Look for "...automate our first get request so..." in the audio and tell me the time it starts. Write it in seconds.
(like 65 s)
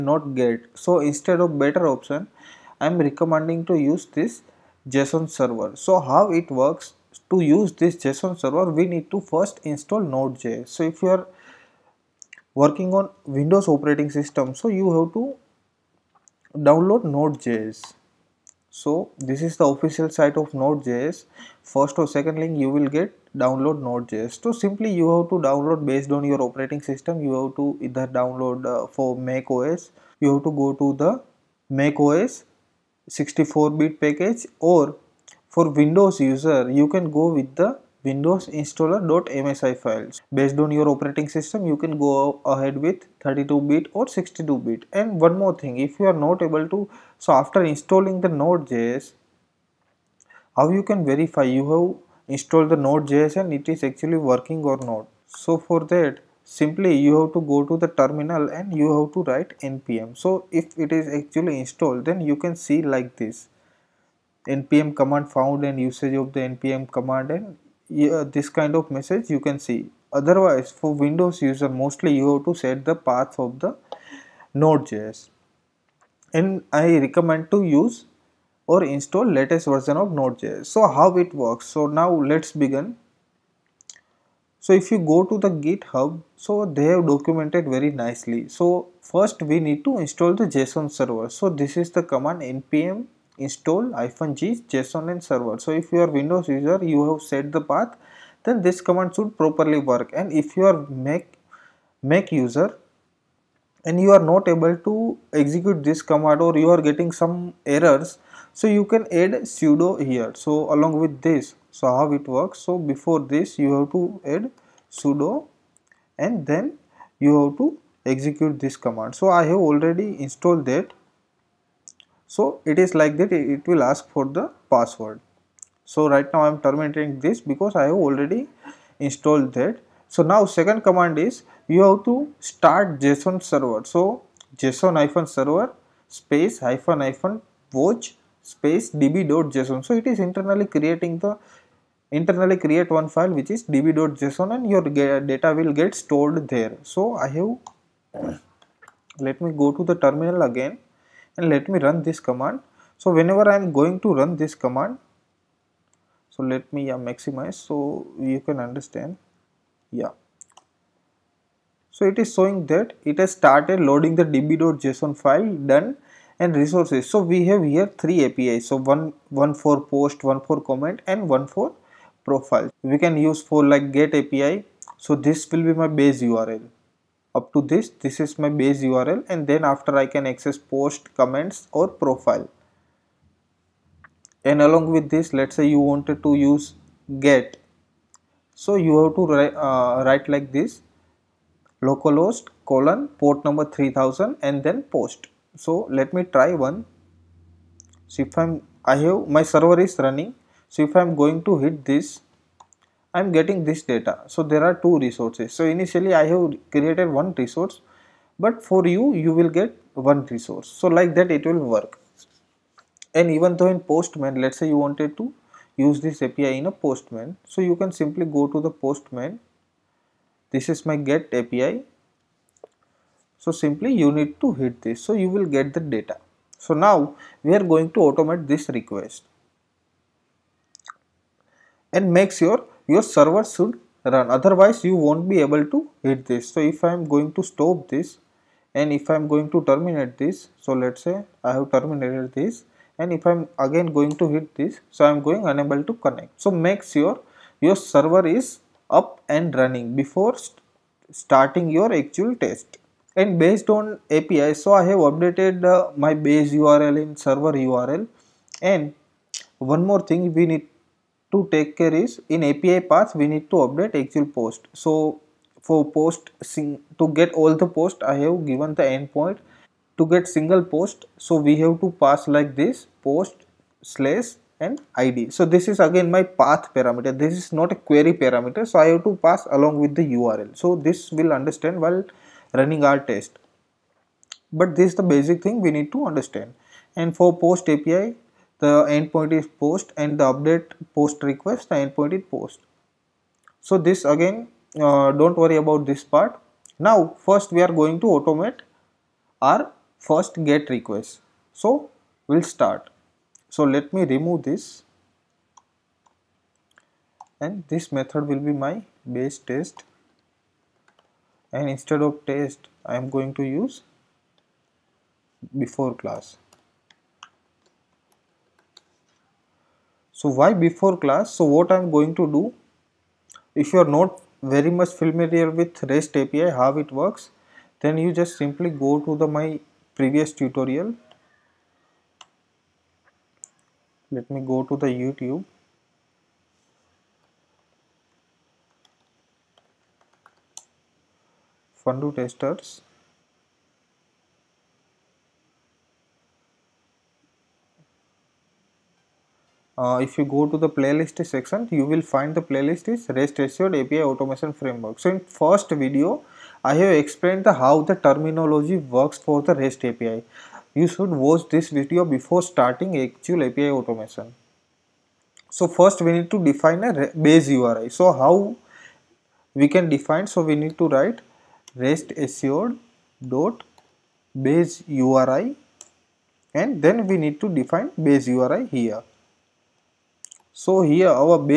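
298 s.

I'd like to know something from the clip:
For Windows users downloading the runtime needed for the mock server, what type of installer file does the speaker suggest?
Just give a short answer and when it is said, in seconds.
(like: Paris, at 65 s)
windows installer.msi, at 38 s.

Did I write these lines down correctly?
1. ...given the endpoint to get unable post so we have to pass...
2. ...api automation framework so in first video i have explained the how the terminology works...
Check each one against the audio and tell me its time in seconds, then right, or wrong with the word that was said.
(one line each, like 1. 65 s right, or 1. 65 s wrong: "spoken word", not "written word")
1. 268 s wrong: "single", not "unable"
2. 353 s right.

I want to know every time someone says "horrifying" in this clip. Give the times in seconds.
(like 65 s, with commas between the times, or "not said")
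not said.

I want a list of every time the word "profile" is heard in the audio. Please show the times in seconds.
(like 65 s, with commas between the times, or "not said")
172 s, 182 s.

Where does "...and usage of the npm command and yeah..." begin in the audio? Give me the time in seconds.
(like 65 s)
65 s.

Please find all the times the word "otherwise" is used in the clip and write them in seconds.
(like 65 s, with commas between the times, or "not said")
70 s, 234 s.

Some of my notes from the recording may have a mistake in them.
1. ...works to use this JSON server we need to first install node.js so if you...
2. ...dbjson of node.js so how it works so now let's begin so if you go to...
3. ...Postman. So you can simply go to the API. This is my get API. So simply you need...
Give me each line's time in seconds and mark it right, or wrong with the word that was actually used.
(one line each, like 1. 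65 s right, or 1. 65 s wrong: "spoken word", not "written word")
1. 6 s right
2. 79 s wrong: "version", not "dbjson"
3. 216 s wrong: "Postman", not "API".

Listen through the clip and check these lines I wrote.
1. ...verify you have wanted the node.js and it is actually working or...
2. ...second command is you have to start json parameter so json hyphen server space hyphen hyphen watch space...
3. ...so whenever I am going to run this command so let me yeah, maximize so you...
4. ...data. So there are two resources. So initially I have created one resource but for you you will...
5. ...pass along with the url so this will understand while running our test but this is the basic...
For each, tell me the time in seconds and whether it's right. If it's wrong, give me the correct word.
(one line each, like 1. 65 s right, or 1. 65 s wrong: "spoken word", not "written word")
1. 51 s wrong: "installed", not "wanted"
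2. 130 s wrong: "server", not "parameter"
3. 152 s right
4. 203 s right
5. 279 s right.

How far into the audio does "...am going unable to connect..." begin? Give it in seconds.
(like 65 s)
245 s.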